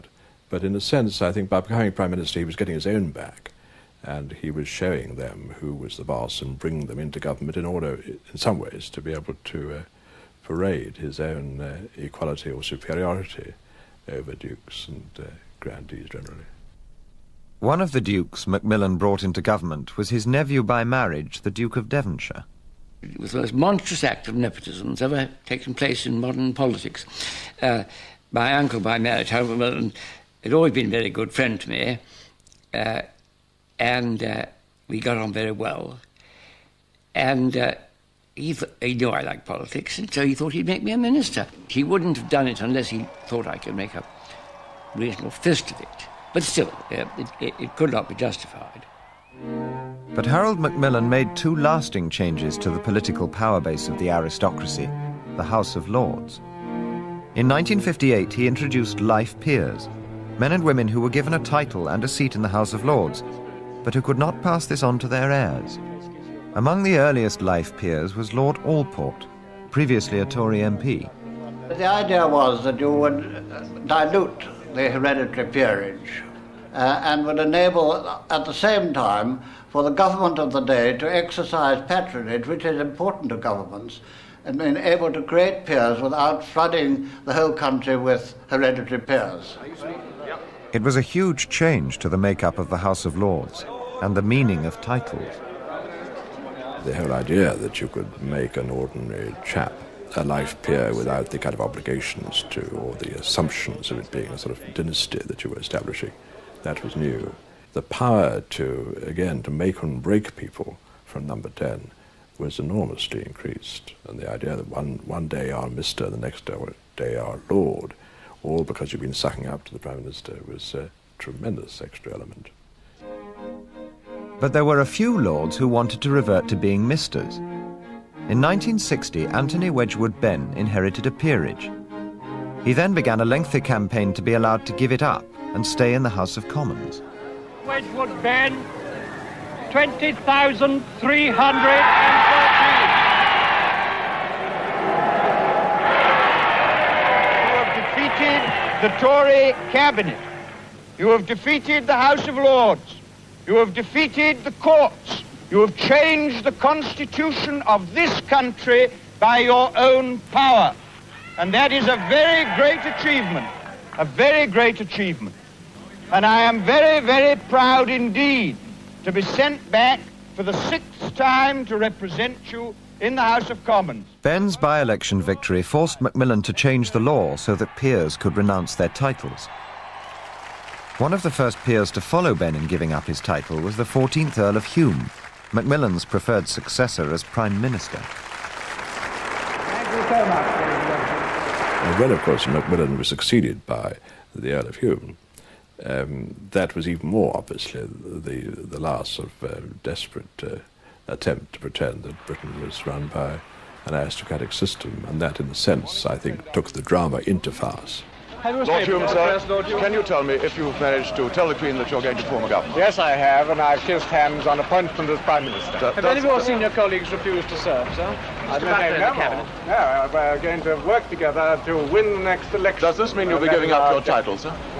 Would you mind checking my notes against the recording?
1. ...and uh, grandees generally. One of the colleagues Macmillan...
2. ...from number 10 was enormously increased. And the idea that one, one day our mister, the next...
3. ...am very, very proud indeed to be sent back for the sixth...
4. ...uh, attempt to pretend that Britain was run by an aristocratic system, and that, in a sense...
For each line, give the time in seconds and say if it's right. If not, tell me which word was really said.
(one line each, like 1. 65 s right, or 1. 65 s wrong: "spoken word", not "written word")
1. 14 s wrong: "dukes", not "colleagues"
2. 111 s right
3. 166 s right
4. 200 s right.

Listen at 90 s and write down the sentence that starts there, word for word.
It was a huge change to the makeup of the House of Lords and the meaning of titles.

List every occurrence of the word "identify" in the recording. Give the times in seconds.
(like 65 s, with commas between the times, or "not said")
not said.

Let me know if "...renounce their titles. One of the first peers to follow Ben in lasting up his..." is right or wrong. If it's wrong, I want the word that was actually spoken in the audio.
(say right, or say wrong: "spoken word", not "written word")
wrong: "giving", not "lasting".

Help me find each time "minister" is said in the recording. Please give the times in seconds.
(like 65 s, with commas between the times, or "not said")
2 s, 40 s, 119 s, 187 s, 215 s.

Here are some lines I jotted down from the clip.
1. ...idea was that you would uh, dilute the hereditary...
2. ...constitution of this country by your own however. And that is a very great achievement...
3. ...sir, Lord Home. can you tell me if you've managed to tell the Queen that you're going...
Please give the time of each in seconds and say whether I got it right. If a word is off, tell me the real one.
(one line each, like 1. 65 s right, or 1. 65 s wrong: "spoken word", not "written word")
1. 71 s right
2. 156 s wrong: "power", not "however"
3. 209 s right.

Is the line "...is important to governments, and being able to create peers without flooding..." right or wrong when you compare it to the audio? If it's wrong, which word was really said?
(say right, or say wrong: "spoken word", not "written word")
right.